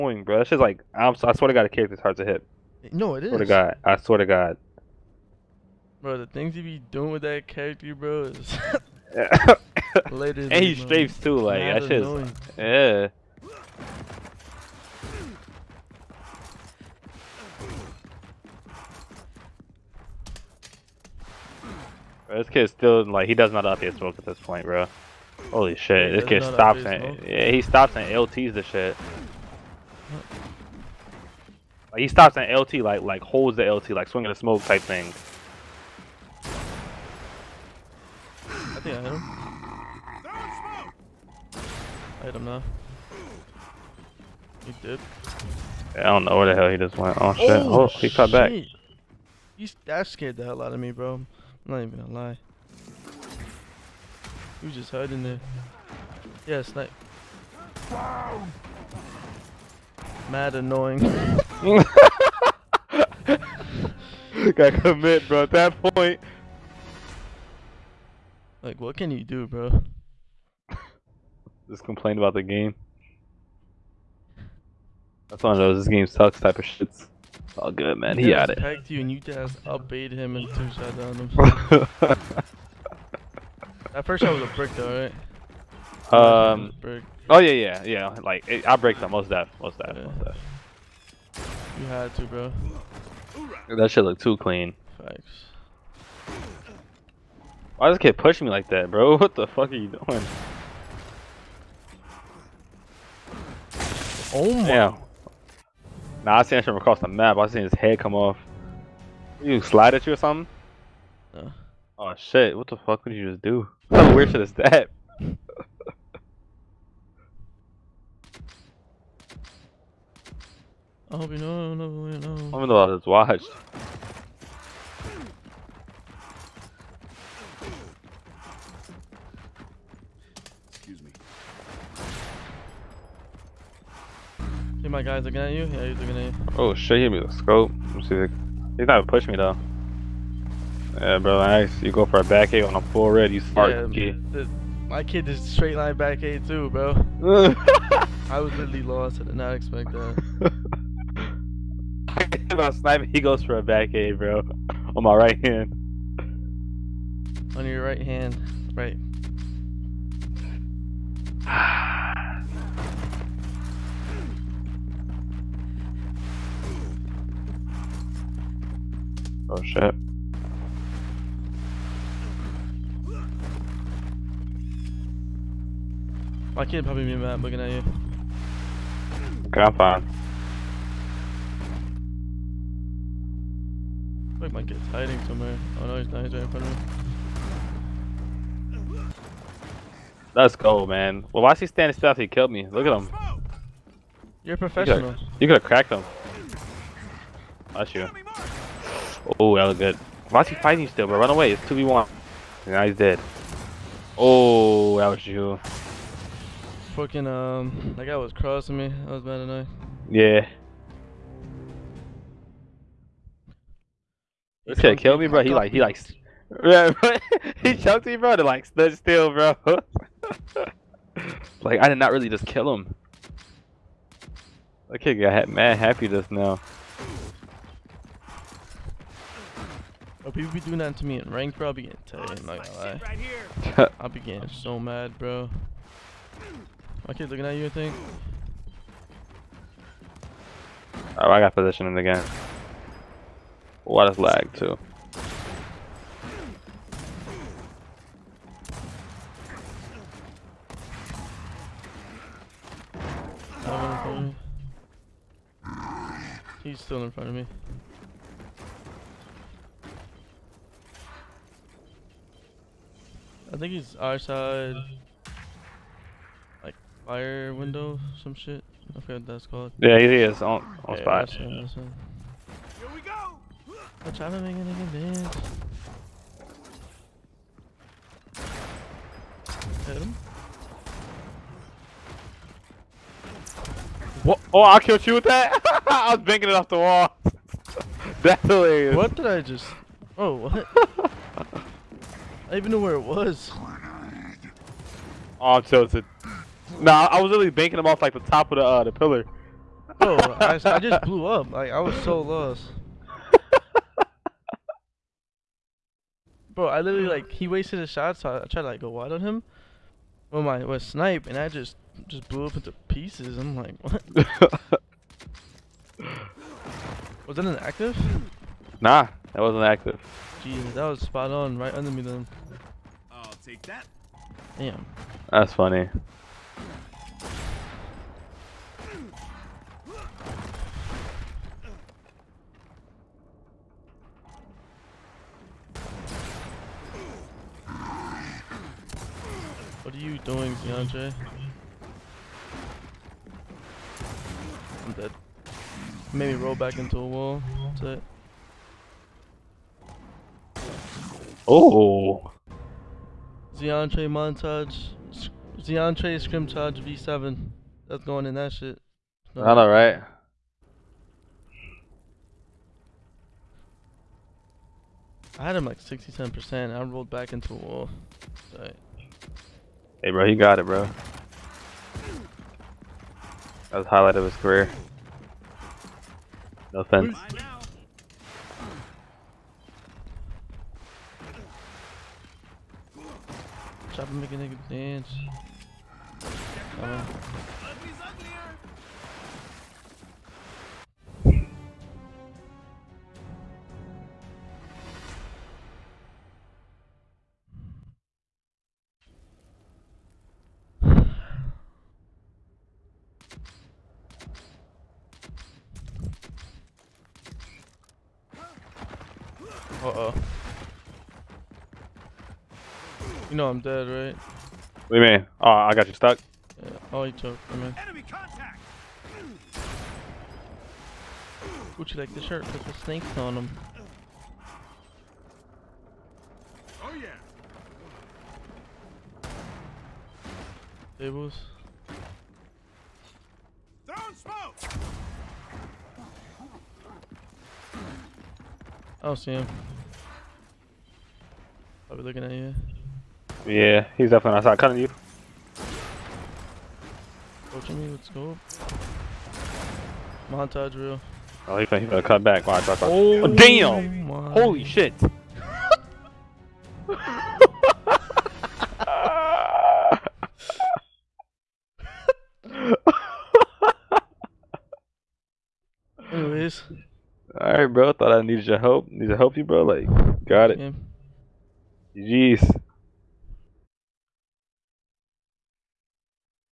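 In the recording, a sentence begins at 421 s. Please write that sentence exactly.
Would you like the shirt with the snakes on them?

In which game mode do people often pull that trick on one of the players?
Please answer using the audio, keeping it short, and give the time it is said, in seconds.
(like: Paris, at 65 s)
rank, at 231 s.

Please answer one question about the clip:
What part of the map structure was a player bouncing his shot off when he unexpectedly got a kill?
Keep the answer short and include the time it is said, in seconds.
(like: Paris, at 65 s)
the pillar, at 298 s.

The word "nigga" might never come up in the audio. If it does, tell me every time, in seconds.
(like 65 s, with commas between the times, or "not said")
274 s, 384 s.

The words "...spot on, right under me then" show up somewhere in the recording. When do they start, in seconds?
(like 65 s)
321 s.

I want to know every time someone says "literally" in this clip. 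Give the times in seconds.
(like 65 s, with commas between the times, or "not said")
148 s, 297 s, 306 s.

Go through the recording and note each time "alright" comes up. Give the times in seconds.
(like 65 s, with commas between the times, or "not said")
359 s, 467 s.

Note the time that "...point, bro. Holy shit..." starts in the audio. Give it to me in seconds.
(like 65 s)
24 s.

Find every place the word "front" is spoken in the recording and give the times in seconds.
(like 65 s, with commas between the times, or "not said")
186 s, 257 s.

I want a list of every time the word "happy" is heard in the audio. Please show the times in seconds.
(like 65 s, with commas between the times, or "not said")
225 s.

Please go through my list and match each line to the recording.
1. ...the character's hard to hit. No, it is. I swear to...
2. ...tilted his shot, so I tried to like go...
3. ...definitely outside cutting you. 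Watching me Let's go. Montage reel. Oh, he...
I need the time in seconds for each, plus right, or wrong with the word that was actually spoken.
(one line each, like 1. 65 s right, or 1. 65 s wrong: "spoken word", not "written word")
1. 1 s right
2. 307 s wrong: "wasted", not "tilted"
3. 444 s right.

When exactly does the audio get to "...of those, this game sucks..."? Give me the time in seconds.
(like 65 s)
75 s.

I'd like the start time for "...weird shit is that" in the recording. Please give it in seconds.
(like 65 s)
114 s.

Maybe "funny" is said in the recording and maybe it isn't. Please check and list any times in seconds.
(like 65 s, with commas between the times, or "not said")
325 s.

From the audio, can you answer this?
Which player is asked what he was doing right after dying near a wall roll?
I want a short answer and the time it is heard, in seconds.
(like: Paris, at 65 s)
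DeAndre, at 340 s.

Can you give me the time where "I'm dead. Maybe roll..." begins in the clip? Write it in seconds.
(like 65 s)
344 s.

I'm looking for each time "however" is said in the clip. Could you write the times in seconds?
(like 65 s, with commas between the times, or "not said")
not said.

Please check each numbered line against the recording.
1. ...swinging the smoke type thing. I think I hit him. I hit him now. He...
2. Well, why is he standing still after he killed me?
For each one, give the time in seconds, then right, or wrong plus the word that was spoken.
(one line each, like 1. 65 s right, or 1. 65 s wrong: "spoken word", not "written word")
1. 34 s right
2. 191 s right.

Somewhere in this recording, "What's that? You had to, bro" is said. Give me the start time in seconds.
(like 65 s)
90 s.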